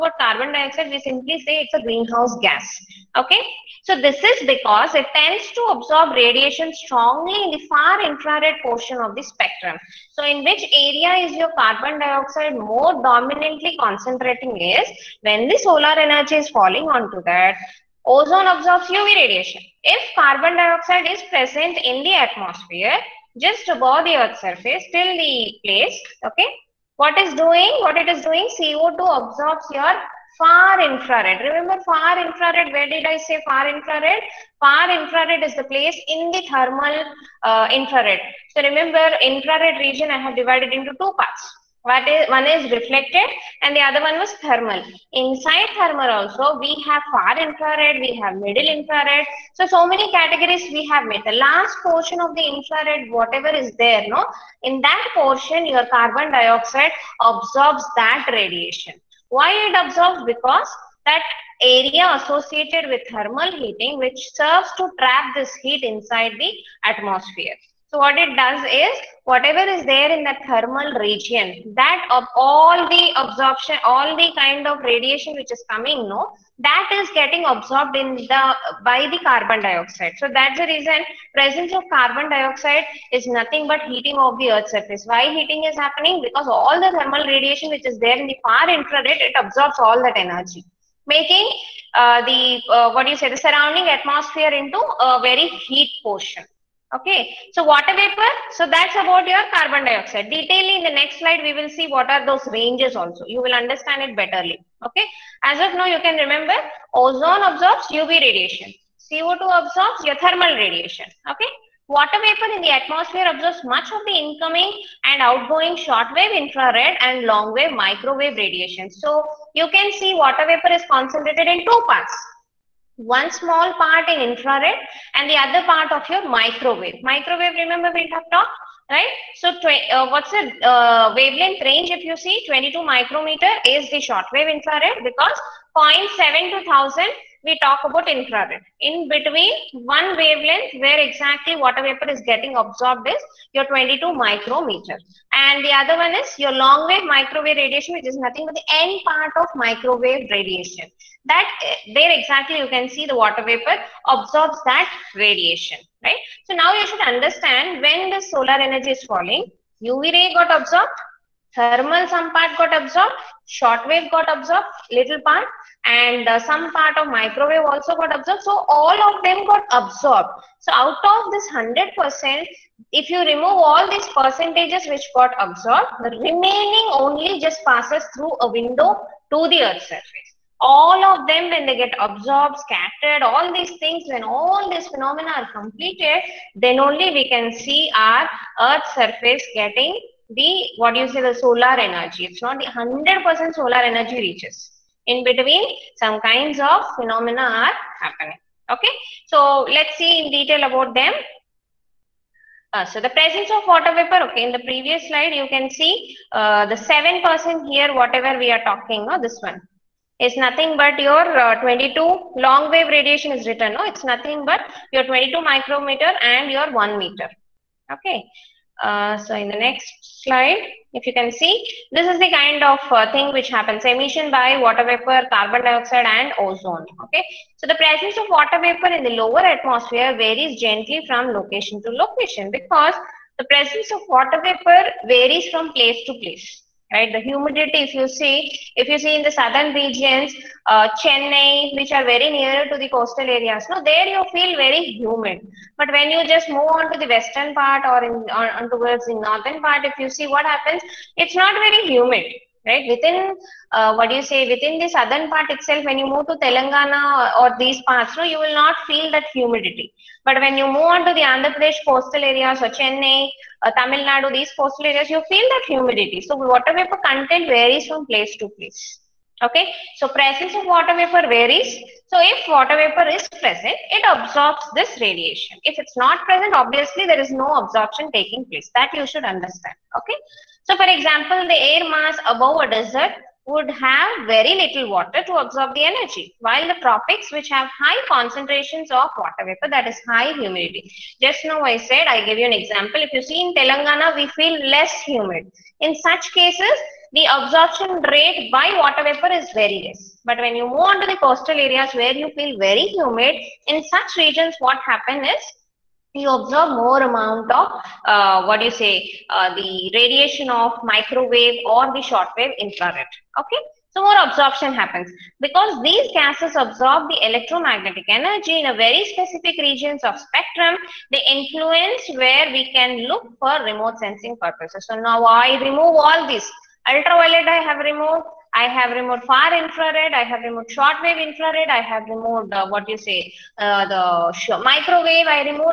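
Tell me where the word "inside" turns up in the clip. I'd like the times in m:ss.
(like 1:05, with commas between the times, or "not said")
0:45, 1:05.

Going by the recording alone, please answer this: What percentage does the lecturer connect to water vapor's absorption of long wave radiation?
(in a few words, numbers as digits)
7%.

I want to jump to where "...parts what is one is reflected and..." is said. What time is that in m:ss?
0:41.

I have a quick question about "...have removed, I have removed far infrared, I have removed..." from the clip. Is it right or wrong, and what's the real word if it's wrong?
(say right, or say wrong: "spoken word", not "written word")
right.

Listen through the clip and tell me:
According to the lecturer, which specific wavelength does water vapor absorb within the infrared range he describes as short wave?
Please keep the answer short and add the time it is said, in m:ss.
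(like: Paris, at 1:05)
22 micrometer, at 2:12.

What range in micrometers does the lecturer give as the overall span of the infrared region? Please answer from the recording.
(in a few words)
0.7 to 1000.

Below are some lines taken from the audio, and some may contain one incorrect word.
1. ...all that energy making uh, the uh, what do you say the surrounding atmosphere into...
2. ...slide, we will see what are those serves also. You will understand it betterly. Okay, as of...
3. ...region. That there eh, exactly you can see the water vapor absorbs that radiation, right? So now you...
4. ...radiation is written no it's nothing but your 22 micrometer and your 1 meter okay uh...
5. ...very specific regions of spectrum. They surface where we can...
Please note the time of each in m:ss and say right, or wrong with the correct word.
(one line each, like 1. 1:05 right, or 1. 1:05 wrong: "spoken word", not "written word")
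1. 1:29 right
2. 1:41 wrong: "ranges", not "serves"
3. 2:30 wrong: "radiation", not "region"
4. 3:32 right
5. 5:18 wrong: "influence", not "surface".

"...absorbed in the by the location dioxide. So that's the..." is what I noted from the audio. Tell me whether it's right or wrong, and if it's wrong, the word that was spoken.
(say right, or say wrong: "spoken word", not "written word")
wrong: "carbon", not "location".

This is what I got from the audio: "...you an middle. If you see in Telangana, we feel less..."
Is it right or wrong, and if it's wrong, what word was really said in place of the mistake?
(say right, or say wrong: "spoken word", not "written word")
wrong: "example", not "middle".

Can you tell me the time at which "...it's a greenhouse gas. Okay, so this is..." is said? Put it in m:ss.
0:01.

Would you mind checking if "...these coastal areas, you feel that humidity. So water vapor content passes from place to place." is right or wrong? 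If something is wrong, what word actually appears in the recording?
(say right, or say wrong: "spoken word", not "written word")
wrong: "varies", not "passes".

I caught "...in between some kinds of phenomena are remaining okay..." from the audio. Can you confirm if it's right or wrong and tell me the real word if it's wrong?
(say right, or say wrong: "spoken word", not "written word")
wrong: "happening", not "remaining".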